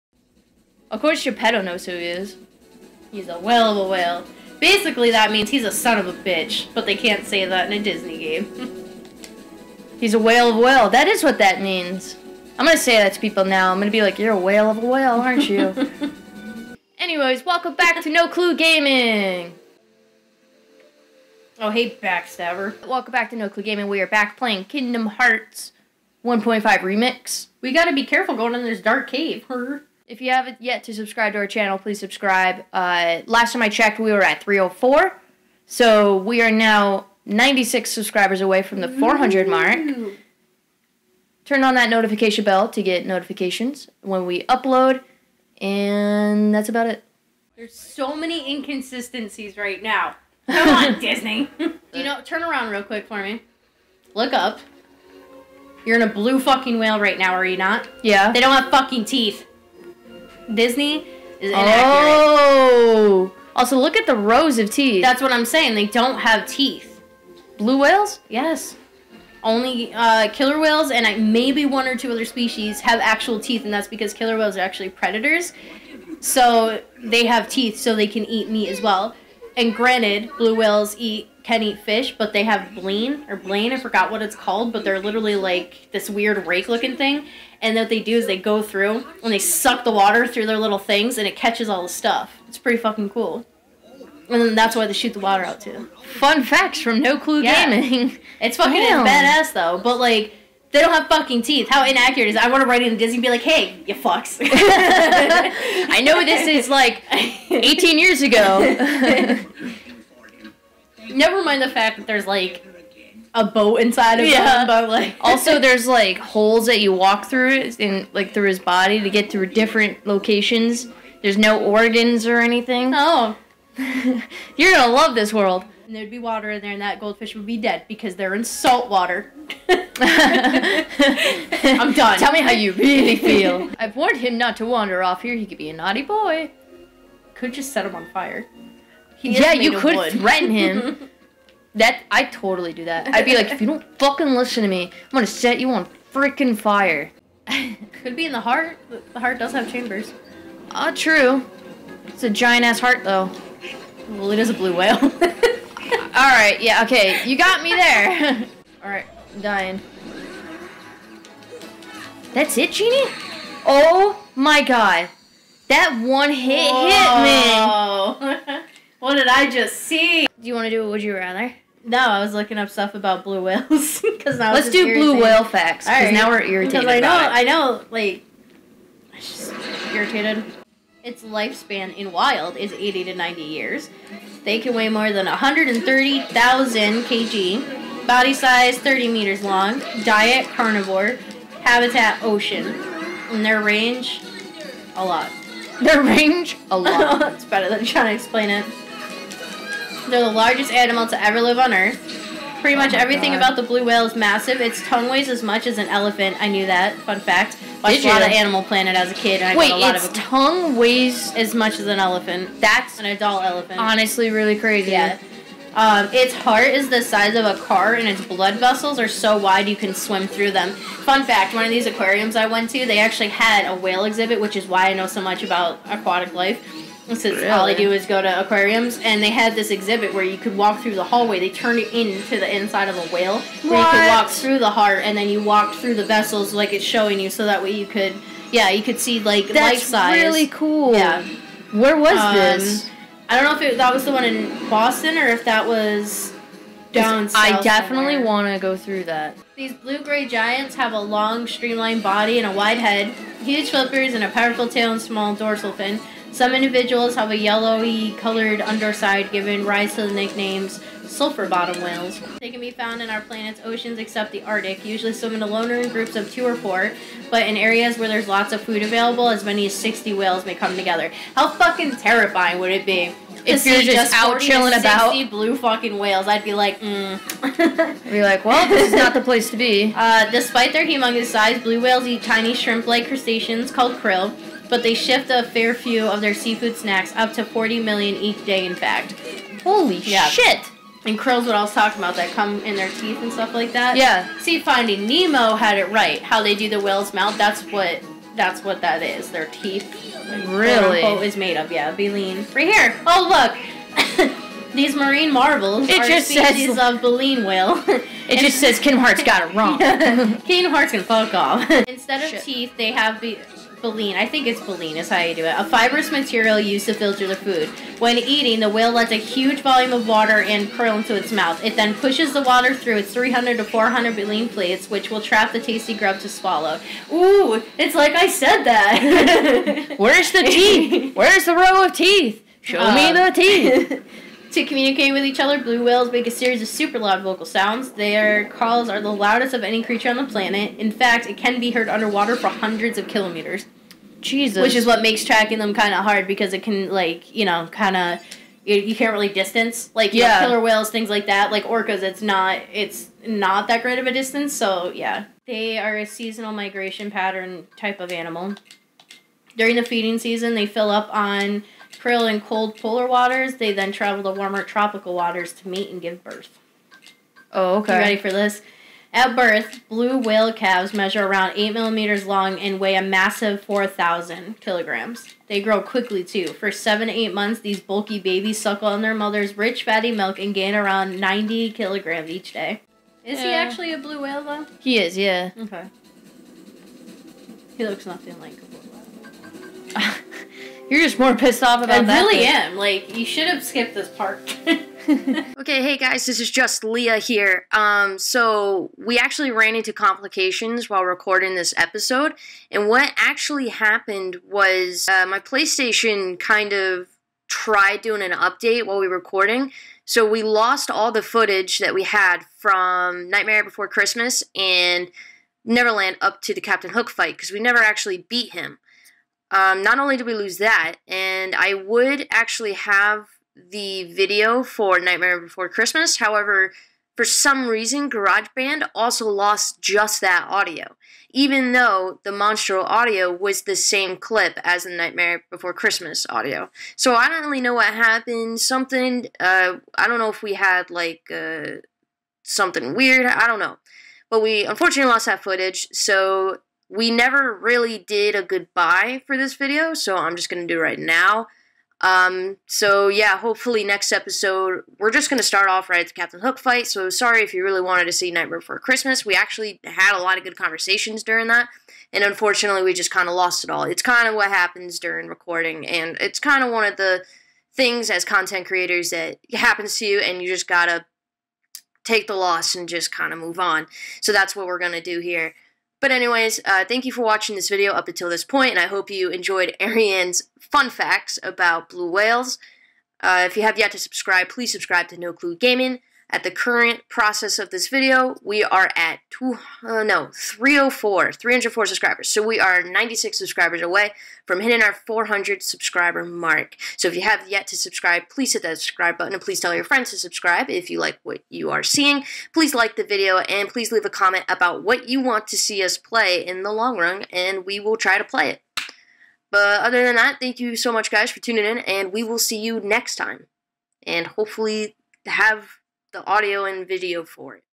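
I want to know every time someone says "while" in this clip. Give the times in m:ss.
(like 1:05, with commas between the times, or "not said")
6:40, 6:48.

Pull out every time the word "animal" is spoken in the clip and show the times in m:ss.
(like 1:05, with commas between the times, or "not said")
3:20, 3:28, 5:58.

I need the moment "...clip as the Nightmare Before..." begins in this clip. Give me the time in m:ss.
7:14.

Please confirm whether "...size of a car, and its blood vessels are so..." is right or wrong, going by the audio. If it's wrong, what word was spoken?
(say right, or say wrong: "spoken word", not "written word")
right.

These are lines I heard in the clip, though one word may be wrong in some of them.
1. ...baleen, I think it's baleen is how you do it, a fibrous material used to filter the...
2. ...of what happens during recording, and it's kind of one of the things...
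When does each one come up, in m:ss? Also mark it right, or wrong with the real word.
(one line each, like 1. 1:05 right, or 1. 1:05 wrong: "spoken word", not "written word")
1. 5:13 right
2. 7:44 right.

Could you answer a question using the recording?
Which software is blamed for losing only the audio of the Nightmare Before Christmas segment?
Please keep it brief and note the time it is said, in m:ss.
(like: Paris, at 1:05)
GarageBand, at 7:08.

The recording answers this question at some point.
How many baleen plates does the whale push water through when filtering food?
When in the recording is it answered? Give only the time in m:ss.
5:23.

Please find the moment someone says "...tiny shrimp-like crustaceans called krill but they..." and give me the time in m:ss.
4:42.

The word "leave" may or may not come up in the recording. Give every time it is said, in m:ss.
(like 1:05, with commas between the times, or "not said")
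8:23.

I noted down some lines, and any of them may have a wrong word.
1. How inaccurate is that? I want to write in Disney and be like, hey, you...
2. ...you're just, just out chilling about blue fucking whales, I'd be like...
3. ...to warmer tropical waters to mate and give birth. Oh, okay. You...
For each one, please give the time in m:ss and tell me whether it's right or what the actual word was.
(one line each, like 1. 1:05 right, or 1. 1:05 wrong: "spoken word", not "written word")
1. 1:41 right
2. 4:33 right
3. 6:04 right.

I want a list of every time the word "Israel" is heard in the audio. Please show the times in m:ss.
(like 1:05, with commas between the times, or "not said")
not said.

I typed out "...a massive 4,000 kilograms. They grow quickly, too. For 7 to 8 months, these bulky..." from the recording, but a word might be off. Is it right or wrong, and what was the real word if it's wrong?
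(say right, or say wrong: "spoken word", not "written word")
right.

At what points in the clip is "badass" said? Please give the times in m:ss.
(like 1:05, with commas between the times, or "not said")
1:39.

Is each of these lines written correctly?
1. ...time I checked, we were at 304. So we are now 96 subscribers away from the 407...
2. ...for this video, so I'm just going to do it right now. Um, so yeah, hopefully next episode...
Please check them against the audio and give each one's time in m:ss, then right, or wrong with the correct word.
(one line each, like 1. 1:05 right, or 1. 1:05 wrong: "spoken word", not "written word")
1. 0:33 wrong: "400", not "407"
2. 7:29 right.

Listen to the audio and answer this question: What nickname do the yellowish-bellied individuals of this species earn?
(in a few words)
Sulfur bottom whales.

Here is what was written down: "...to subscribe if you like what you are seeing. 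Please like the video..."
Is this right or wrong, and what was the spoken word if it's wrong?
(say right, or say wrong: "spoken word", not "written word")
right.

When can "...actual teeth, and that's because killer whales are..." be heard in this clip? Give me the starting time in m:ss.
1:12.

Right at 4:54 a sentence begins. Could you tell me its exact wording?
See, Finding Nemo had it right.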